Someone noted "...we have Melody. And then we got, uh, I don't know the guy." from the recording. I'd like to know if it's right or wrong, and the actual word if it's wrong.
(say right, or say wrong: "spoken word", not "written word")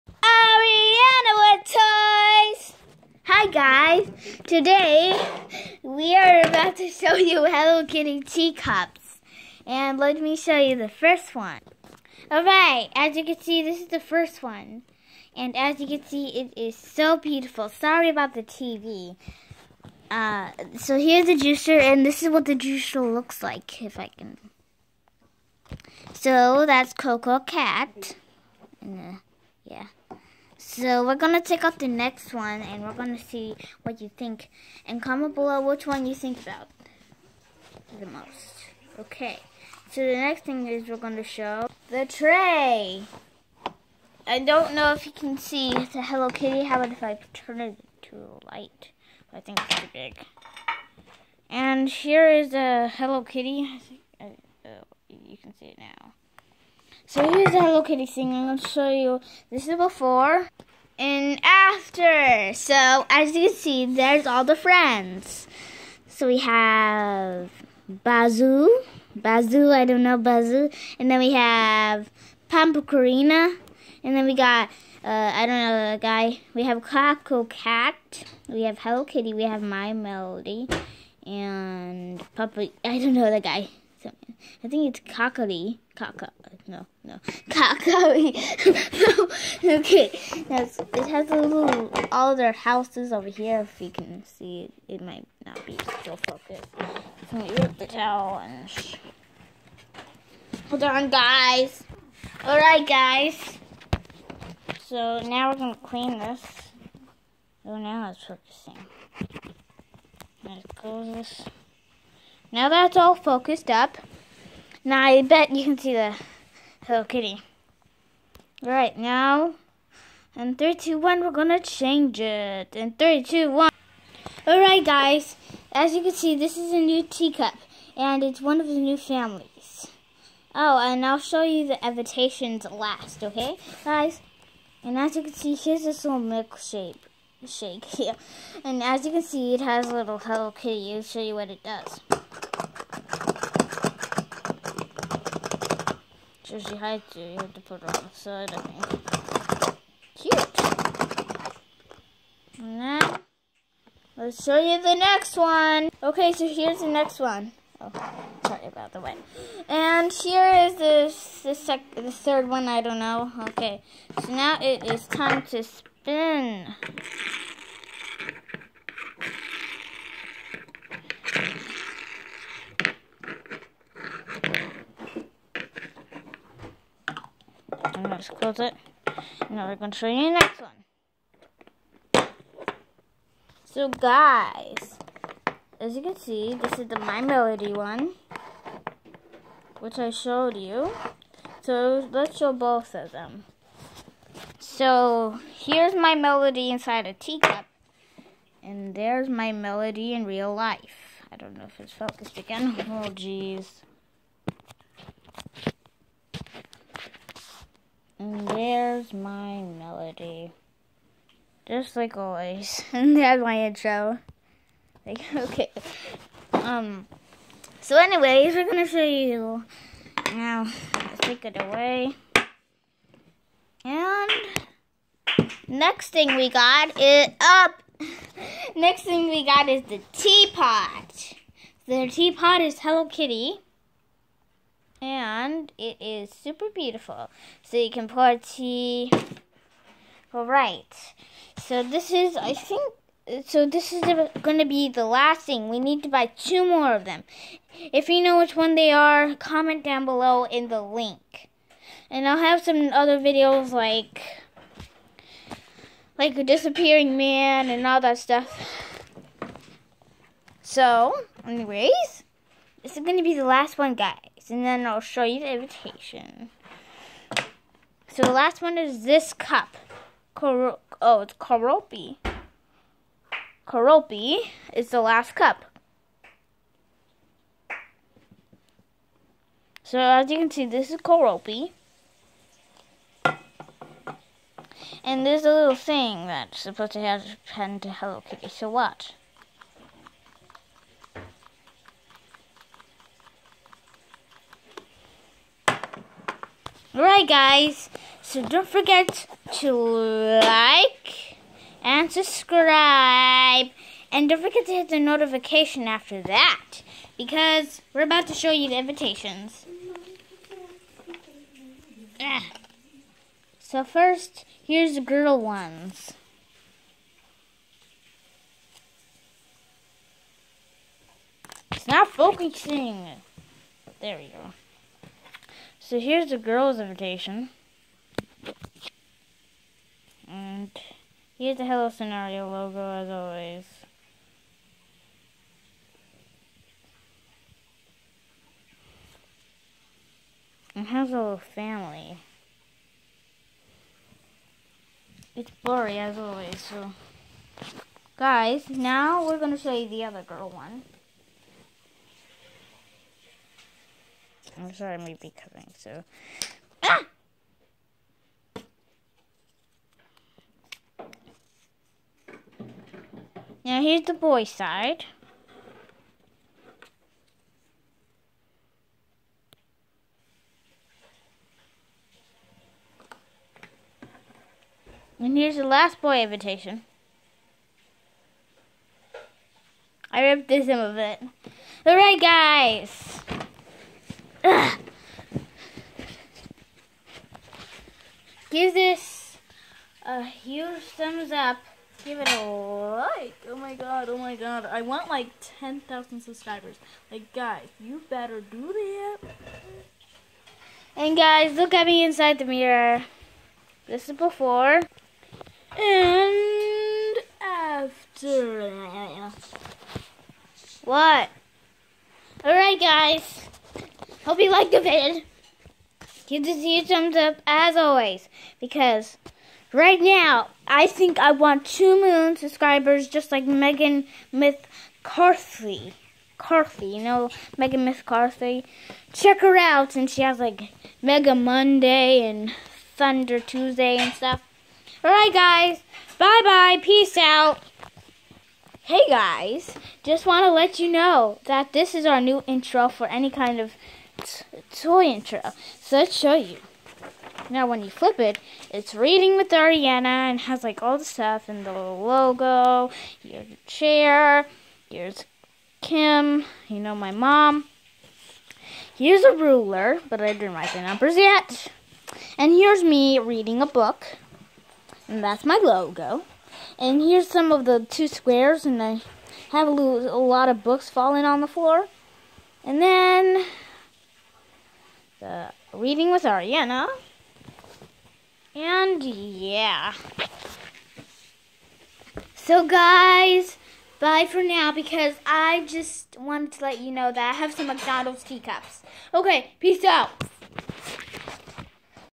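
wrong: "Pampacarina", not "Melody".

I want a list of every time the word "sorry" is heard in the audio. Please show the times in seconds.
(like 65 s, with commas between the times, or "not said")
17 s, 158 s, 354 s.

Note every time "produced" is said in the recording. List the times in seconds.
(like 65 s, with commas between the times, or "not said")
not said.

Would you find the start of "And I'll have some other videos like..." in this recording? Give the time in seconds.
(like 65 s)
252 s.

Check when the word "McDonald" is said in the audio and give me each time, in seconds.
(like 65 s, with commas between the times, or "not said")
487 s.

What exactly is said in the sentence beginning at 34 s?
And comment below which one you think about the most.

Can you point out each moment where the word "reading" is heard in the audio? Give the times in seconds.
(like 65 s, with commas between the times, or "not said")
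448 s, 463 s, 475 s.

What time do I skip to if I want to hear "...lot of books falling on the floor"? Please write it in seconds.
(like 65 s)
470 s.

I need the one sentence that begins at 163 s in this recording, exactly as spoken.
Okay, so now it is time to spin.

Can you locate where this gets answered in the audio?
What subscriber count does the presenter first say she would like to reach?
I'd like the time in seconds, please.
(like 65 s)
395 s.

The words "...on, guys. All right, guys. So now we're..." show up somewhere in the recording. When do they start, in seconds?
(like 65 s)
100 s.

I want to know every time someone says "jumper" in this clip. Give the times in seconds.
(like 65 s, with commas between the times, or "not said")
not said.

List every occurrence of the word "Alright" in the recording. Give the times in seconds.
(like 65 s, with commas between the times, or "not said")
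12 s, 124 s, 296 s, 381 s, 412 s, 435 s.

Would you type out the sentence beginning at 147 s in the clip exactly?
You have to put it on the side, I think.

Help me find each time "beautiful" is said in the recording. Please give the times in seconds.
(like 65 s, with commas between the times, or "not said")
17 s, 236 s.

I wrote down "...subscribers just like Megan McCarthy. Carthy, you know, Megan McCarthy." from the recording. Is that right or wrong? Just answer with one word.
right.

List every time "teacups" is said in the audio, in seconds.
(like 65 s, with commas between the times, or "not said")
8 s, 127 s, 197 s, 488 s.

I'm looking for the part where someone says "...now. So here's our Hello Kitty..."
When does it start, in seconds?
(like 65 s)
55 s.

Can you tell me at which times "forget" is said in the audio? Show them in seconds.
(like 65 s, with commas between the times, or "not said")
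298 s, 304 s.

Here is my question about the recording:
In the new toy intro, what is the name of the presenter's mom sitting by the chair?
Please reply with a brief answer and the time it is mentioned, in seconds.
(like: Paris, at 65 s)
Kim, at 455 s.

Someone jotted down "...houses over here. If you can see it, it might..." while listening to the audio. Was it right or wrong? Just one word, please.
right.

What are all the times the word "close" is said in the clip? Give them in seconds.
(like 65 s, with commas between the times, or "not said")
110 s, 178 s.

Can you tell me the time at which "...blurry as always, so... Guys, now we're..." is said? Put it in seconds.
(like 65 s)
345 s.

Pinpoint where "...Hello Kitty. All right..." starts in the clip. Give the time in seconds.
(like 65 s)
116 s.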